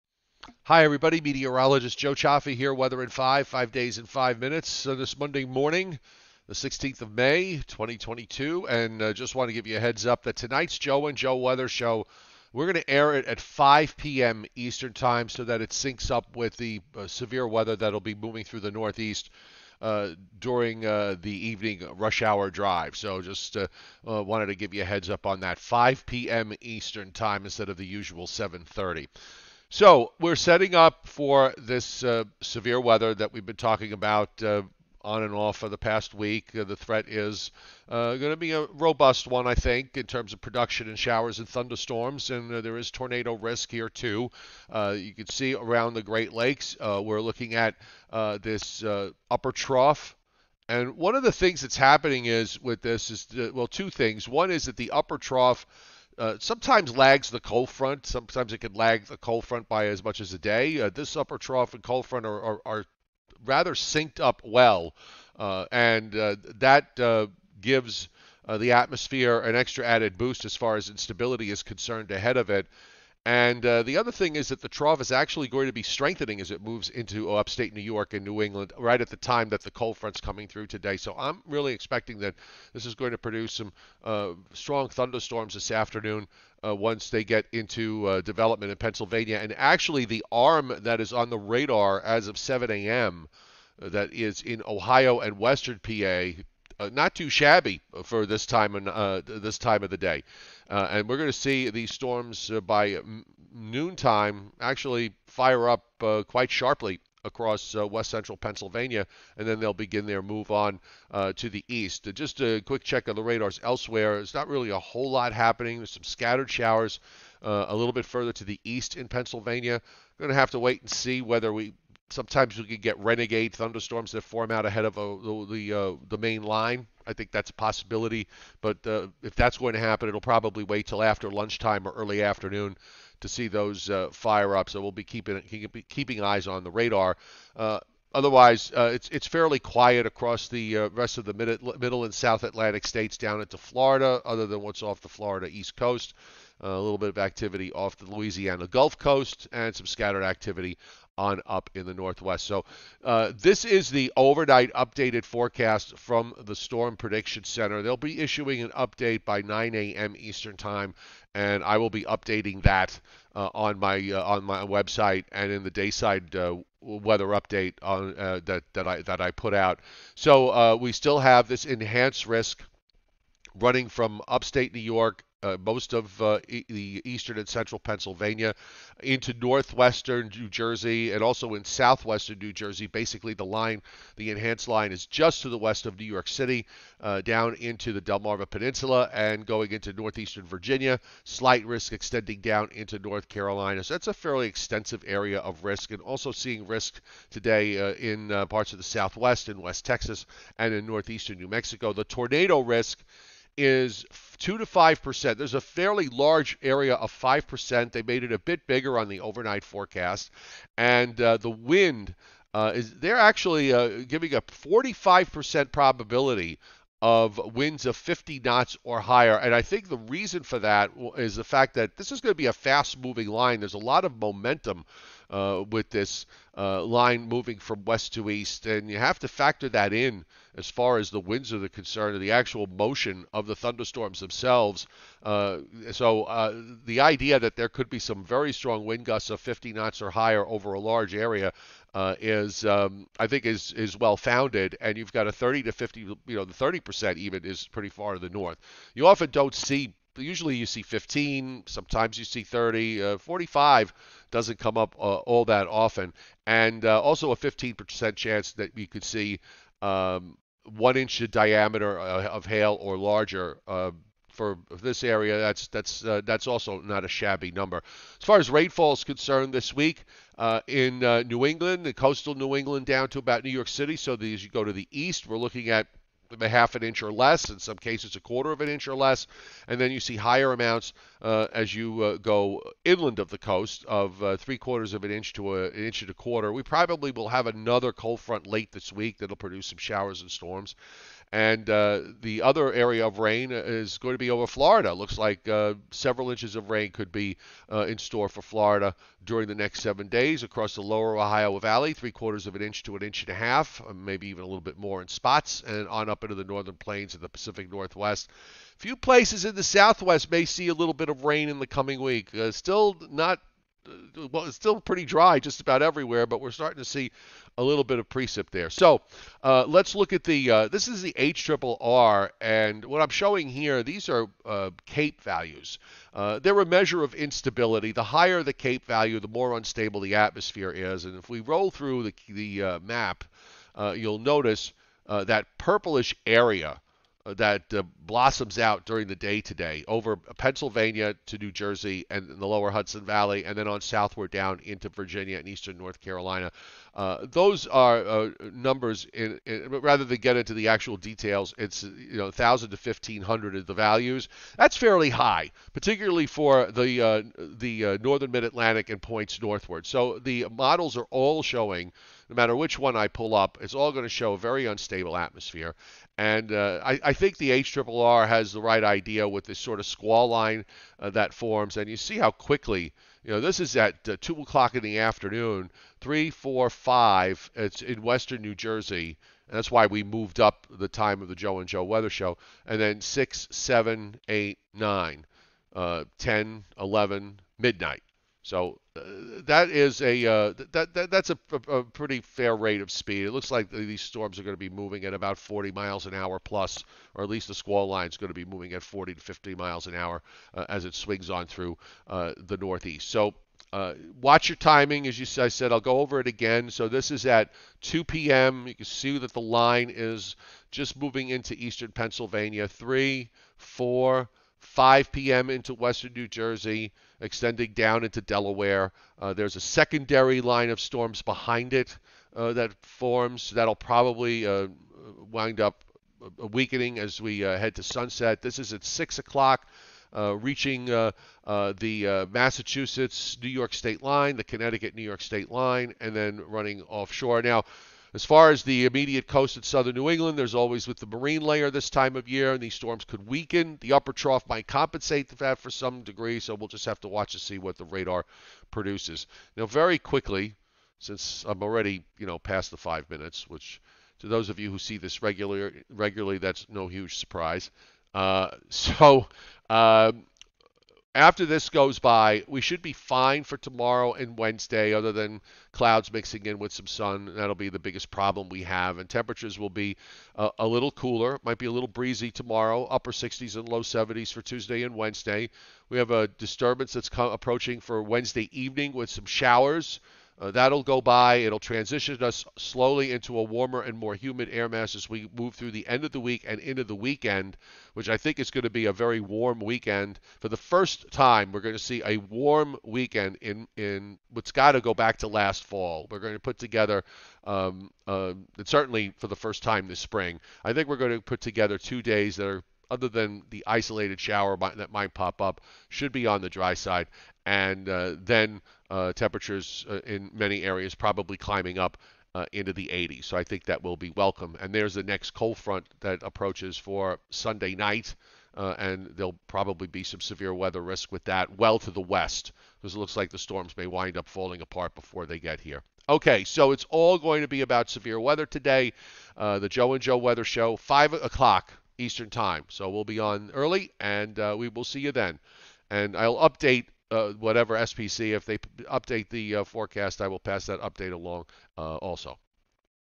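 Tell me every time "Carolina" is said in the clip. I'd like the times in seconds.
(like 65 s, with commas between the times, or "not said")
193 s, 345 s.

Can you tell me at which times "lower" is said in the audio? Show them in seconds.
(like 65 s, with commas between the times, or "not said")
300 s, 342 s.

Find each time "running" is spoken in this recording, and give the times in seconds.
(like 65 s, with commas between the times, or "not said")
173 s, 436 s.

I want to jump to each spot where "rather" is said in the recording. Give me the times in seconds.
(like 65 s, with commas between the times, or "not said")
63 s, 349 s.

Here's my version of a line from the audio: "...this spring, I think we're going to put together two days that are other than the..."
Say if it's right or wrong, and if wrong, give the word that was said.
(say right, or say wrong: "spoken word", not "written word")
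right.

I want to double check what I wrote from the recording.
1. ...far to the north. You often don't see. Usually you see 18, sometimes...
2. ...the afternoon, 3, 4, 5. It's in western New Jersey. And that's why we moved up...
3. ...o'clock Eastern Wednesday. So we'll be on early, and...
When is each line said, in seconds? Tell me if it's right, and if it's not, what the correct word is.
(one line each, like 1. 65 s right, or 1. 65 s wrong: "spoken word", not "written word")
1. 247 s wrong: "15", not "18"
2. 374 s right
3. 531 s wrong: "Time", not "Wednesday".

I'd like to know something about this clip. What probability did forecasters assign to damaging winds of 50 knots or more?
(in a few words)
45%.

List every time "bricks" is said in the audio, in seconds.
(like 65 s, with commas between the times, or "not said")
not said.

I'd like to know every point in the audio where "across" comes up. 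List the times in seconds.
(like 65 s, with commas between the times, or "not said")
107 s, 140 s, 300 s.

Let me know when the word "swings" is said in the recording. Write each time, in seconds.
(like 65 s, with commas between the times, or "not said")
400 s.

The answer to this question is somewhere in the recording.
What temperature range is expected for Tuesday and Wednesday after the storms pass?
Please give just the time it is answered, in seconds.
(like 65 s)
472 s.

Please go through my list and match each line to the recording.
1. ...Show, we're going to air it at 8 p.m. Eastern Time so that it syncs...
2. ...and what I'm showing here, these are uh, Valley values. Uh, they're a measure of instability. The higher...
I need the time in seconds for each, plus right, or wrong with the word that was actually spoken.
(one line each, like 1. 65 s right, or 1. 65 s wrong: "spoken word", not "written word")
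1. 11 s wrong: "5", not "8"
2. 322 s wrong: "CAPE", not "Valley".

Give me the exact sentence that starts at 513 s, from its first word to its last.
So I think that will be welcome.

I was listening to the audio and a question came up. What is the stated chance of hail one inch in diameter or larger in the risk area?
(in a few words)
15%.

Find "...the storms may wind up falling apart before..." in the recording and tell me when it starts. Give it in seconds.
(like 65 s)
523 s.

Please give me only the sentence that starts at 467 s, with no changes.
That'll be the biggest problem we have.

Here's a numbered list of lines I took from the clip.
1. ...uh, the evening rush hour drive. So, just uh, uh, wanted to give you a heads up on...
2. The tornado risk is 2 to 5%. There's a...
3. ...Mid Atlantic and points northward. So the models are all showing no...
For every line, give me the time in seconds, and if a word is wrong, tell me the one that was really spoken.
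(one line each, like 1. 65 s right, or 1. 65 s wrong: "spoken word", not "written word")
1. 20 s right
2. 201 s right
3. 358 s right.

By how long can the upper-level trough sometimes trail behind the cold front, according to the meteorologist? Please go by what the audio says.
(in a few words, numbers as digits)
a day.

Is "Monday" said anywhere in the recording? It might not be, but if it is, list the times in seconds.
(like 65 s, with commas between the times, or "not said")
5 s.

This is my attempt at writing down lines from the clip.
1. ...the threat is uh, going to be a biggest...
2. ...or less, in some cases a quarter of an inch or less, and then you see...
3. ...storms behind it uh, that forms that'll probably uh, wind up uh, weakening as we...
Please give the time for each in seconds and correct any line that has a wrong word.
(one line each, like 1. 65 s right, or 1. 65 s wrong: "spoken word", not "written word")
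1. 36 s wrong: "robust", not "biggest"
2. 277 s right
3. 420 s right.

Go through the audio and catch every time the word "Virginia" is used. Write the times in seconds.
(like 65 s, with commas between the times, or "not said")
190 s, 344 s.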